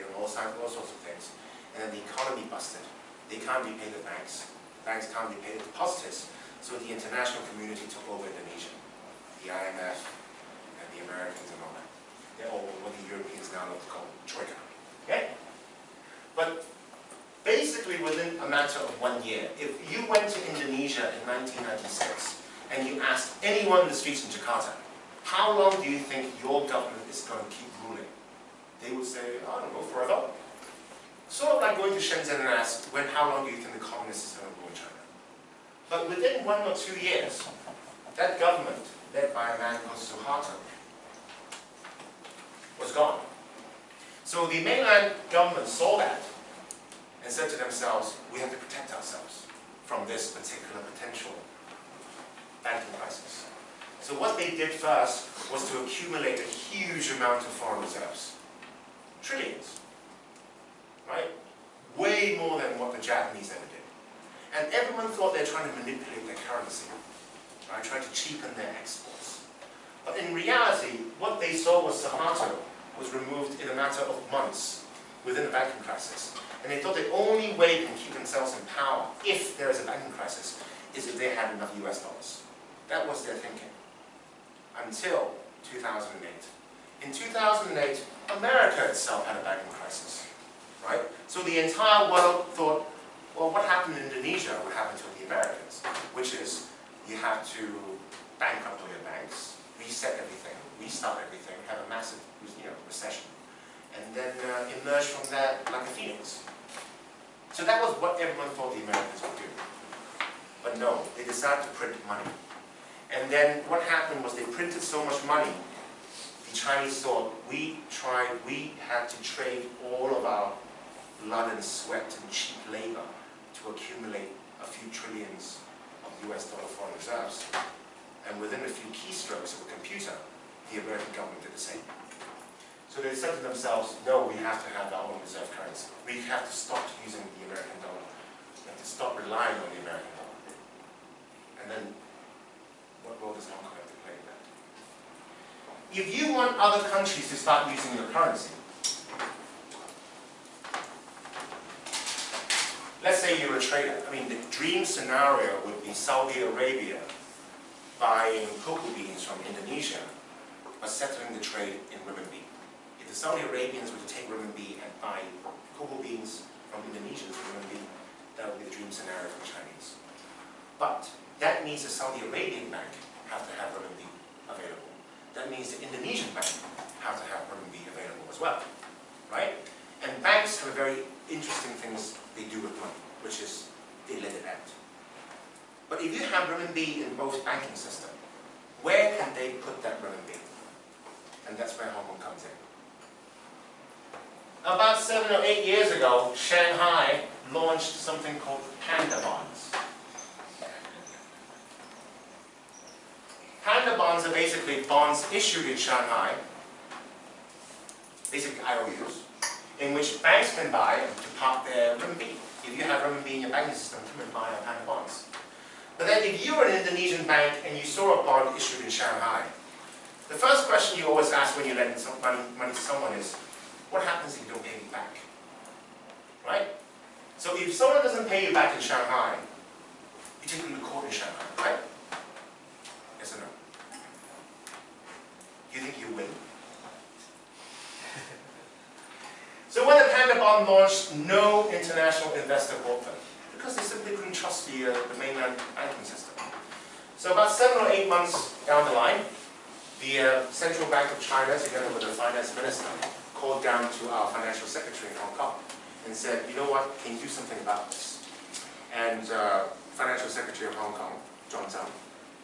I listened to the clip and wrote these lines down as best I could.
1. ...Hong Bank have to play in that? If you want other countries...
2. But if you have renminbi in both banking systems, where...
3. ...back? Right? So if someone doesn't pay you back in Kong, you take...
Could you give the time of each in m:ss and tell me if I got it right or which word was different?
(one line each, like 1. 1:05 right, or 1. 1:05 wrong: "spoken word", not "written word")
1. 2:23 wrong: "Kong", not "Bank"
2. 3:05 right
3. 3:44 wrong: "Shanghai", not "Kong".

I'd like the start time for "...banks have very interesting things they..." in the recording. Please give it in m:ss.
3:00.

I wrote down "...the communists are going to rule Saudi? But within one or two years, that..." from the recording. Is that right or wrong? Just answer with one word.
wrong.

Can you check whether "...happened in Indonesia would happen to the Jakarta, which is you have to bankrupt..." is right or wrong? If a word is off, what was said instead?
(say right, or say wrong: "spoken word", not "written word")
wrong: "Americans", not "Jakarta".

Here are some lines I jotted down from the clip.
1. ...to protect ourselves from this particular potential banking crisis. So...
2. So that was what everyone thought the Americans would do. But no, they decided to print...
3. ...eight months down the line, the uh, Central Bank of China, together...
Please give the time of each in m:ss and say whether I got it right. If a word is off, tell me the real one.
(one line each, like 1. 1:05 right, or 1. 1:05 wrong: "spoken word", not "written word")
1. 0:48 right
2. 1:47 right
3. 4:07 right.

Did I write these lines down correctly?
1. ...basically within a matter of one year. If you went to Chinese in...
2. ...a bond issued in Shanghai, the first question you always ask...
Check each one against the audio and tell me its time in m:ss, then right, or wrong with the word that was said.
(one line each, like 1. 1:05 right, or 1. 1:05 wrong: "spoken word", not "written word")
1. 0:17 wrong: "Indonesia", not "Chinese"
2. 3:38 right.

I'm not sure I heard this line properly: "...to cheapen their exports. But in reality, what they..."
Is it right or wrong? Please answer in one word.
right.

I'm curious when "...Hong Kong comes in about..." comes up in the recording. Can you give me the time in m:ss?
3:11.